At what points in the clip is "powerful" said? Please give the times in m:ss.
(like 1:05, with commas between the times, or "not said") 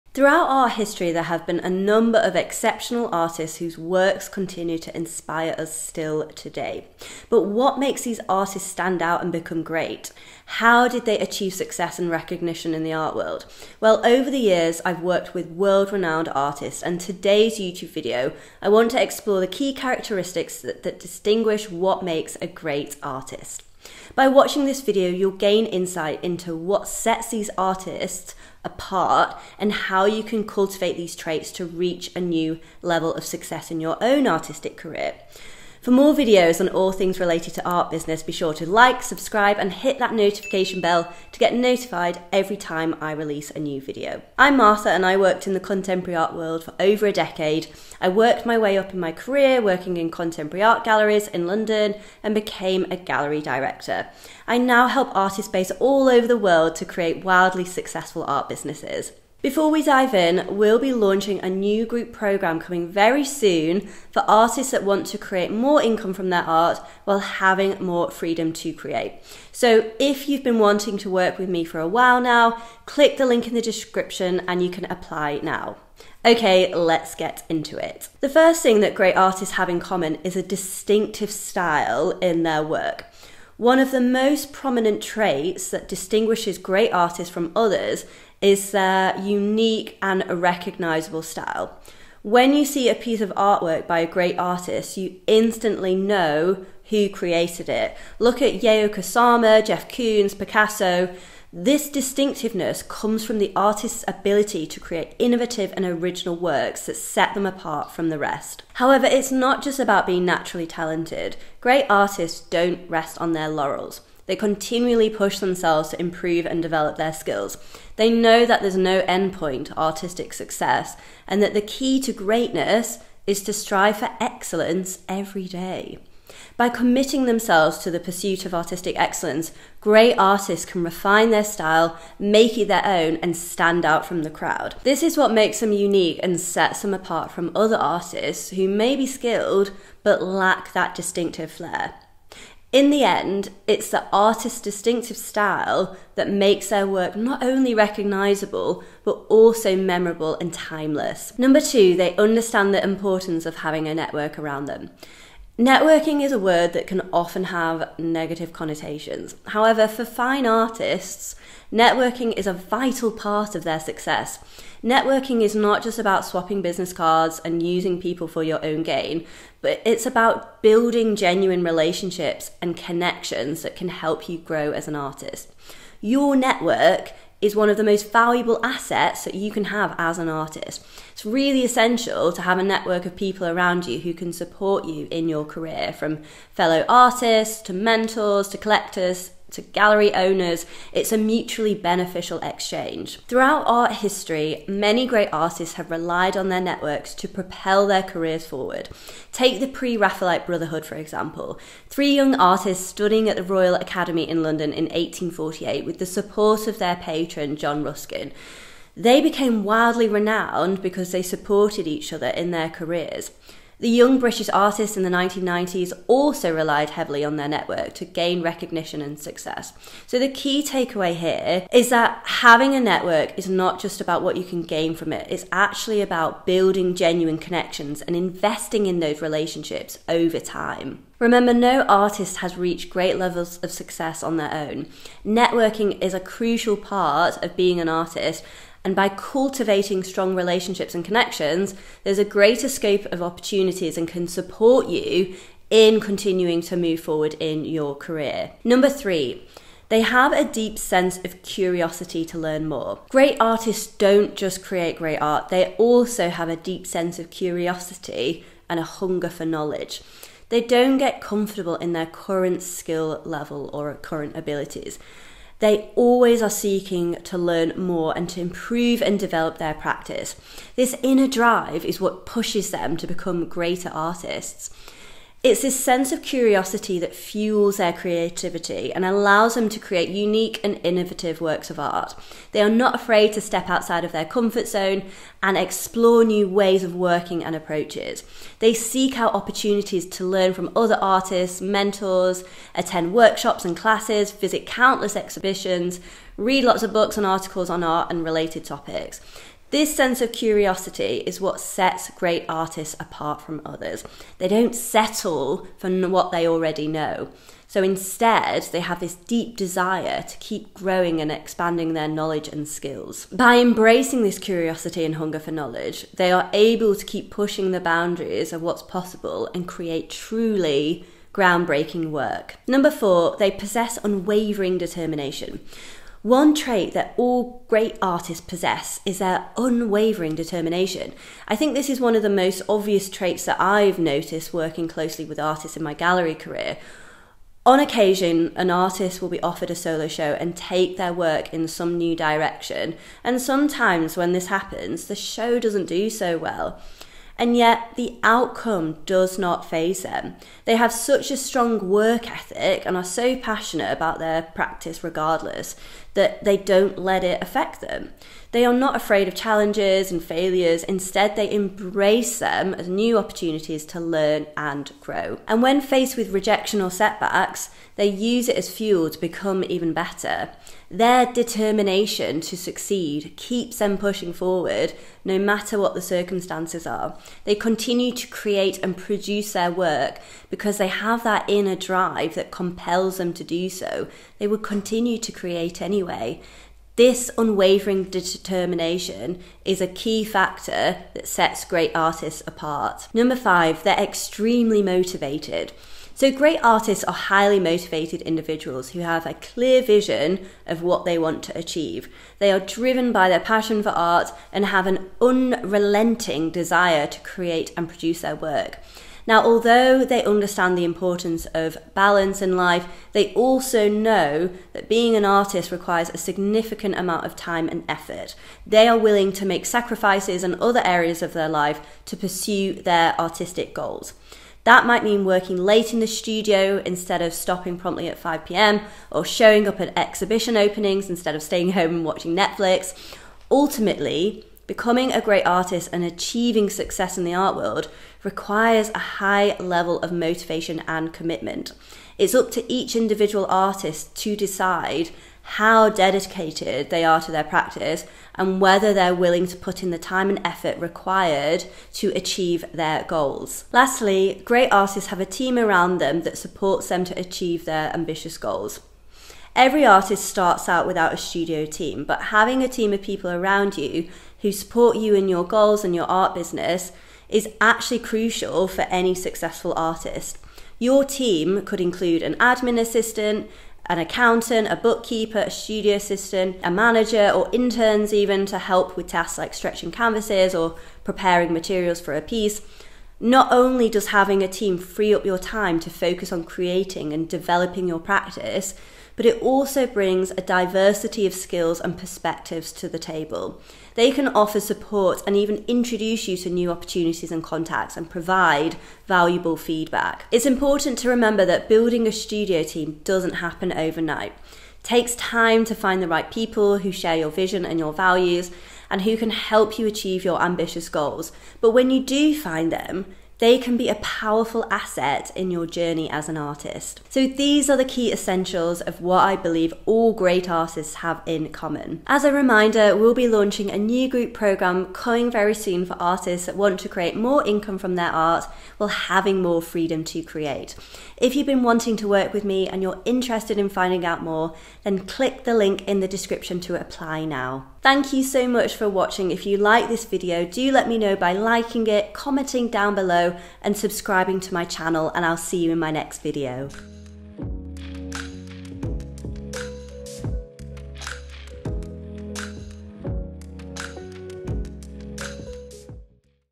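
8:33.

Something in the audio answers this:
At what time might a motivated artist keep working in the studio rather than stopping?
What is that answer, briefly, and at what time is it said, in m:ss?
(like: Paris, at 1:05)
5 pm, at 7:08.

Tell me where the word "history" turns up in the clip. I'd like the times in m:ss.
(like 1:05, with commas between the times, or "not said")
0:00, 3:13.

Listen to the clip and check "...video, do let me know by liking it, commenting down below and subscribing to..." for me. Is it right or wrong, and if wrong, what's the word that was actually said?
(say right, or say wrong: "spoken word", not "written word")
right.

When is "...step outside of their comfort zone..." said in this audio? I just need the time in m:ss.
4:43.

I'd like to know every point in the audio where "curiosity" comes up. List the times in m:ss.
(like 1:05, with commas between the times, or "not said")
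4:11, 4:17, 4:36, 5:00, 5:14.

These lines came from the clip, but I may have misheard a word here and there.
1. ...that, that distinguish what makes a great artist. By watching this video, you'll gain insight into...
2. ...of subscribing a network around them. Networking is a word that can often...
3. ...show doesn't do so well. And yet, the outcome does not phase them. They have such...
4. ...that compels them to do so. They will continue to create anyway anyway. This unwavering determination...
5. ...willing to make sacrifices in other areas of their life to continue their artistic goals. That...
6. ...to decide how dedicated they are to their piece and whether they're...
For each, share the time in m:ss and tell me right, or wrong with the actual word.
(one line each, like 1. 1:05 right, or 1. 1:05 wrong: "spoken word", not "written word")
1. 0:20 right
2. 2:33 wrong: "having", not "subscribing"
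3. 5:45 right
4. 6:22 right
5. 6:58 wrong: "pursue", not "continue"
6. 7:24 wrong: "practice", not "piece".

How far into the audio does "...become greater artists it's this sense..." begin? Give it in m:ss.
4:33.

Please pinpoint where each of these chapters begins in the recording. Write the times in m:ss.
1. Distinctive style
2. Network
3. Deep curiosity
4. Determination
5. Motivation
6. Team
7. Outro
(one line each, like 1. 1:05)
1. 1:18
2. 2:31
3. 4:09
4. 5:22
5. 6:33
6. 7:34
7. 8:37.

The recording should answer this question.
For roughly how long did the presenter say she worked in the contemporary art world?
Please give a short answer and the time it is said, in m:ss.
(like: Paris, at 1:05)
over a decade, at 0:46.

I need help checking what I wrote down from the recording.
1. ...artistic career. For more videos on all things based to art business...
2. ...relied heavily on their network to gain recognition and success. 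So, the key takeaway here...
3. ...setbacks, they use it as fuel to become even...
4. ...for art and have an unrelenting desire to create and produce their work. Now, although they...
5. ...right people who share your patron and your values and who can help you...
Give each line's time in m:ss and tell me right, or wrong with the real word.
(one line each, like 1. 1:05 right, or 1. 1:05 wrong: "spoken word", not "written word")
1. 0:34 wrong: "related", not "based"
2. 3:36 right
3. 6:06 right
4. 6:43 right
5. 8:26 wrong: "vision", not "patron".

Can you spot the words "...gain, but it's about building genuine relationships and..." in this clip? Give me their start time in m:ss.
2:48.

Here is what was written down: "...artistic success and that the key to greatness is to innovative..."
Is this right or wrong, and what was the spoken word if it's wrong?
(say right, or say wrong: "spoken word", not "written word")
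wrong: "strive", not "innovative".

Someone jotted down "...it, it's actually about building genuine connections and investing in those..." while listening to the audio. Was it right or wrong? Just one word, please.
right.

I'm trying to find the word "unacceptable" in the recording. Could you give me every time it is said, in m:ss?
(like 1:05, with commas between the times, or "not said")
not said.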